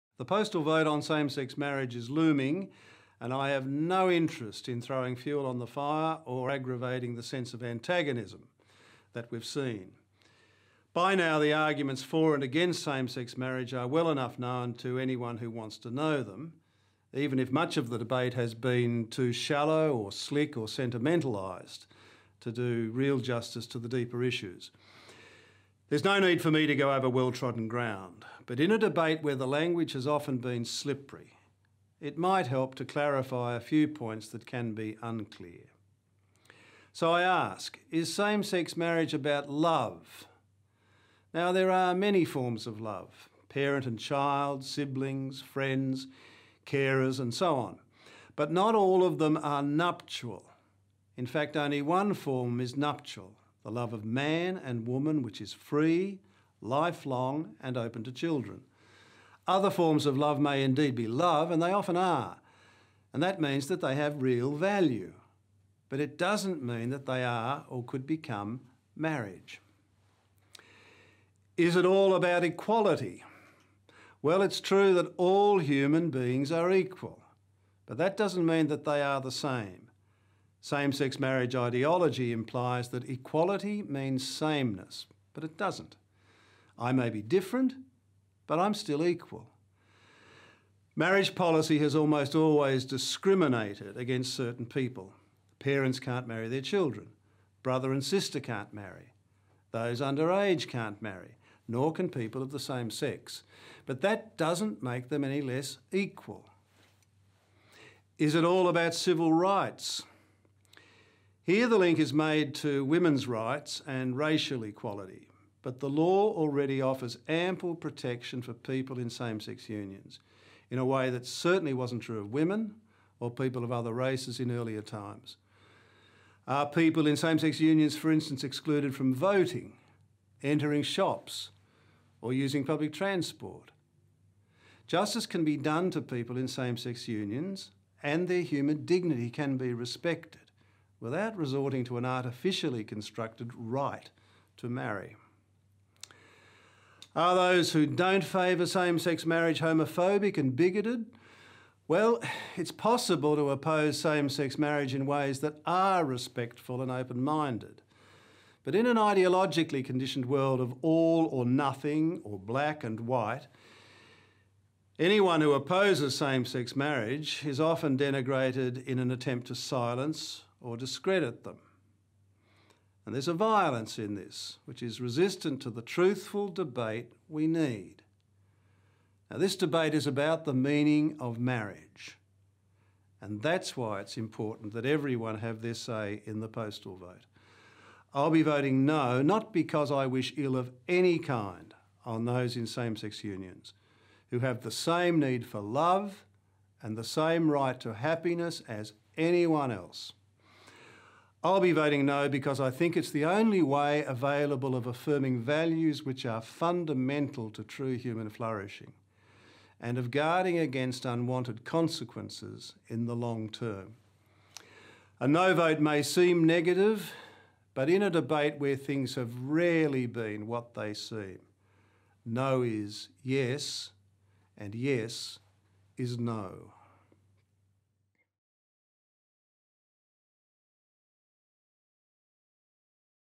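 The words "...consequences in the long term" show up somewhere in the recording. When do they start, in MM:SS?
03:31.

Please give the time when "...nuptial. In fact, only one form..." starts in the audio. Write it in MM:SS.
00:49.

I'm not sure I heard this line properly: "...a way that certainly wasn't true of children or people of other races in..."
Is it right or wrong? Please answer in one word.
wrong.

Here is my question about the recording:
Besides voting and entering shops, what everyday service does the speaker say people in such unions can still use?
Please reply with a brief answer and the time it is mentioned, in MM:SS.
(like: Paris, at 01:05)
Public transport, at 02:12.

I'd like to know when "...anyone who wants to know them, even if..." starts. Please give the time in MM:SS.
00:14.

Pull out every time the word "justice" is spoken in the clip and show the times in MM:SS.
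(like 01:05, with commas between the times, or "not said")
00:23, 02:14.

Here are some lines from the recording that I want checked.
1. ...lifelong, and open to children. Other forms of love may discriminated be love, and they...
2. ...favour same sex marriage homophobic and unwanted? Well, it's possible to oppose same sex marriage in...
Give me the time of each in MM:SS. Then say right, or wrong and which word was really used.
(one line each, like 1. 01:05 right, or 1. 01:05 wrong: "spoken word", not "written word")
1. 00:56 wrong: "indeed", not "discriminated"
2. 02:28 wrong: "bigoted", not "unwanted".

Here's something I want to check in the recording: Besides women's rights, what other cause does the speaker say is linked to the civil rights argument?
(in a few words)
Racial equality.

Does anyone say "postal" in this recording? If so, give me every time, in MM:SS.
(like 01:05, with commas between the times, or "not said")
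00:00, 03:06.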